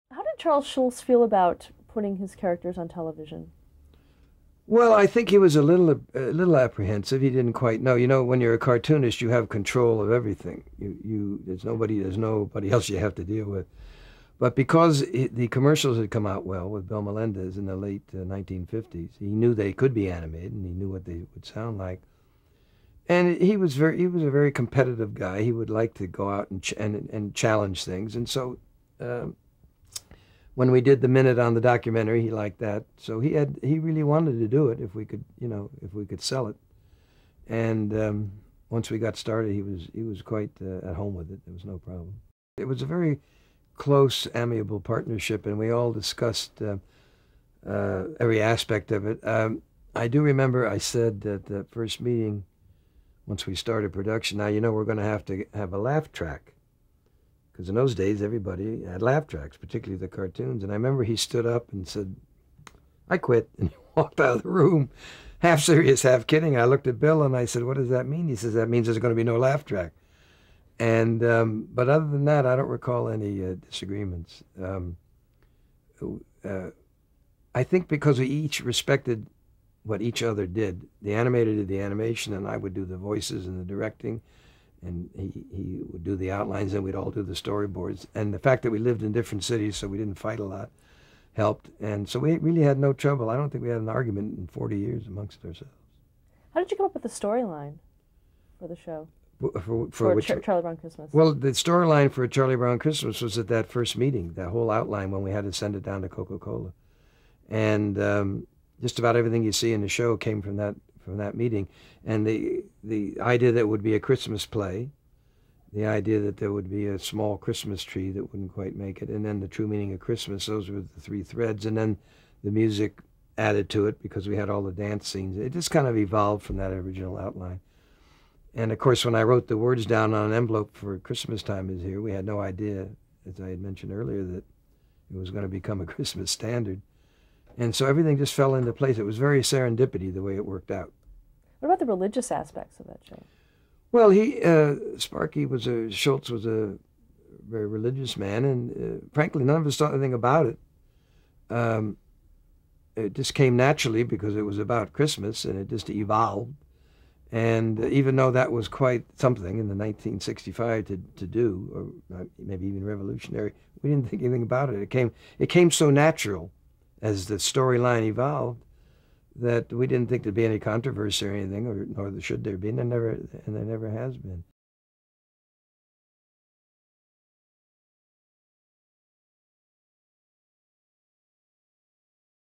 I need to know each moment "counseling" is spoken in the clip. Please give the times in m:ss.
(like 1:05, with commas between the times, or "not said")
not said.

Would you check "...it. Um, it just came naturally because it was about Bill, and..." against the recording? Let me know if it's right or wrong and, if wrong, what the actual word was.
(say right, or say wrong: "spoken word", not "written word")
wrong: "Christmas", not "Bill".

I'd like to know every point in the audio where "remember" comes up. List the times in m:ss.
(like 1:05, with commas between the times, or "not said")
0:50, 1:00.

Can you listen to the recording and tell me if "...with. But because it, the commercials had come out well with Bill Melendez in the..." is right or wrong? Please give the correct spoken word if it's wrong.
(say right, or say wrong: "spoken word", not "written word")
right.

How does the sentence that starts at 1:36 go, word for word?
How did you come up with the storyline for the show?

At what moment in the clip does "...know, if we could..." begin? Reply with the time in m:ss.
0:35.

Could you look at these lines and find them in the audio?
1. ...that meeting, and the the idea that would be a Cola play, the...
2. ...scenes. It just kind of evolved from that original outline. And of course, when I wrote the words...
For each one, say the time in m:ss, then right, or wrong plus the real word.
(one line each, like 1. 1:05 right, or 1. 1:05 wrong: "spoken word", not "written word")
1. 1:51 wrong: "Christmas", not "Cola"
2. 2:05 right.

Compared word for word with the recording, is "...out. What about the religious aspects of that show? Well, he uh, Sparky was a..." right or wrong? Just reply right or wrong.
right.